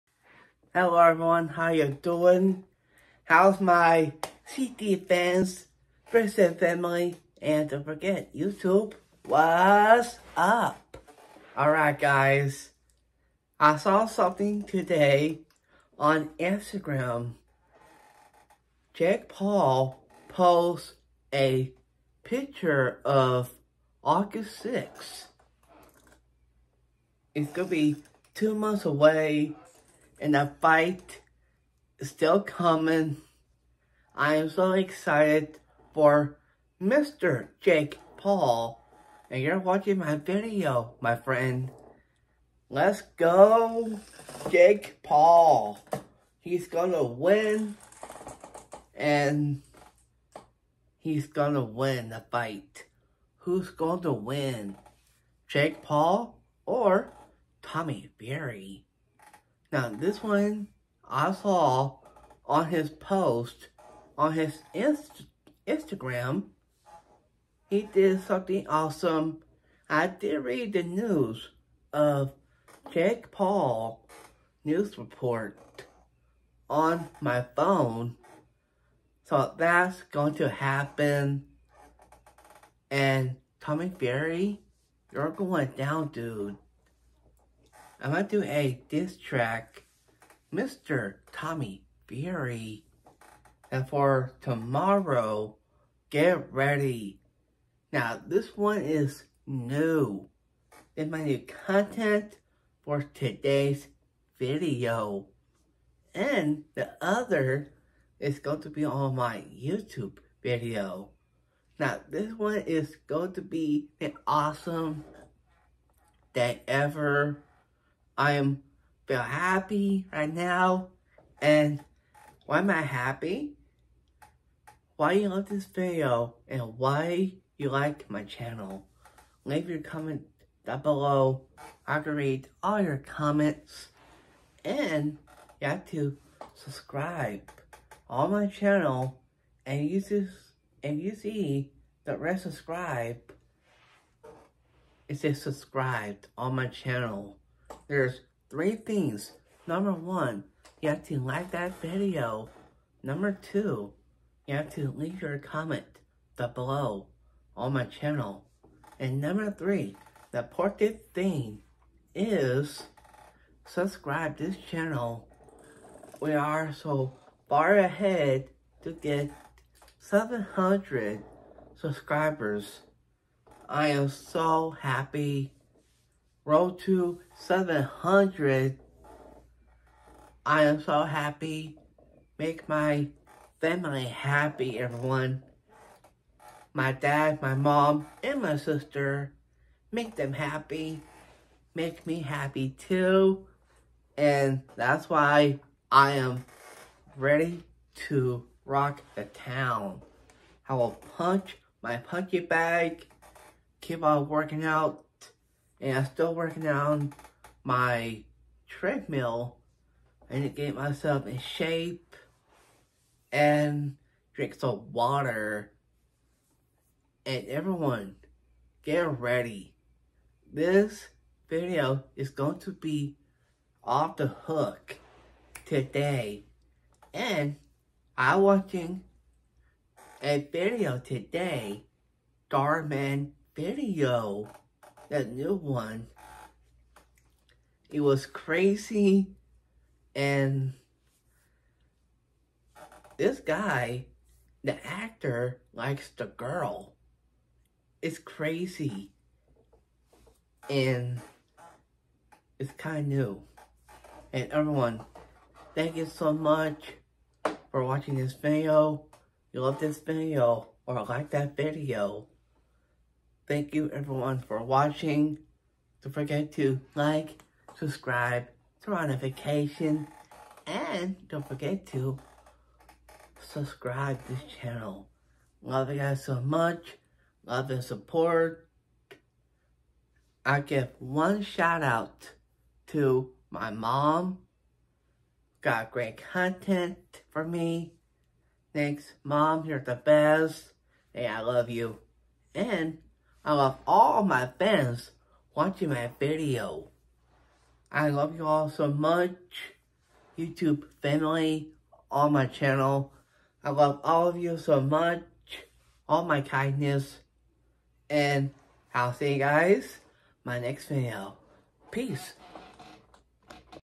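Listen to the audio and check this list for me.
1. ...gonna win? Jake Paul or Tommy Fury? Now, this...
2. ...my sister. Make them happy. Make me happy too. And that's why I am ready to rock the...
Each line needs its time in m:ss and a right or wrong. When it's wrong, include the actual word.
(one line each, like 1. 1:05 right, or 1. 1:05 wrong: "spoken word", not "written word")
1. 0:53 right
2. 3:08 right.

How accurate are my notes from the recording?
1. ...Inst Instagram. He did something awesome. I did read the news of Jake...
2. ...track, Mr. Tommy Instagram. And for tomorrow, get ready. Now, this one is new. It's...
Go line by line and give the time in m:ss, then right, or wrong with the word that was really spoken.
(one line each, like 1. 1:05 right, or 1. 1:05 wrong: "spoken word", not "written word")
1. 1:04 right
2. 1:29 wrong: "Fury", not "Instagram".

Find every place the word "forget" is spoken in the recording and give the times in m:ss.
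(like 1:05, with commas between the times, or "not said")
0:07, 4:26, 4:31.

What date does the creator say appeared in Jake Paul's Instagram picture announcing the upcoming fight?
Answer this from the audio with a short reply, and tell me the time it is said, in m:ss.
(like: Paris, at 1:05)
August 6th, at 0:24.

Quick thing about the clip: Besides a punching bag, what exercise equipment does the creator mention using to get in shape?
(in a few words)
Treadmill.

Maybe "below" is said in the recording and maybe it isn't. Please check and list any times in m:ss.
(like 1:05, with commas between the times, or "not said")
2:10, 2:36.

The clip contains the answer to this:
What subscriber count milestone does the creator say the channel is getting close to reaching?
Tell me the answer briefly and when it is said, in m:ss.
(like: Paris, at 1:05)
700, at 2:49.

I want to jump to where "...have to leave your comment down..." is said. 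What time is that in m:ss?
2:34.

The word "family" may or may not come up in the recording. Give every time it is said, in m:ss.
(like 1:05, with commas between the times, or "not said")
0:06, 3:03, 5:01.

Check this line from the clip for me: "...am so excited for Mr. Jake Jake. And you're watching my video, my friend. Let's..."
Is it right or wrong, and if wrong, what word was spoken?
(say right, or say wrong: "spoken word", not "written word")
wrong: "Paul", not "Jake".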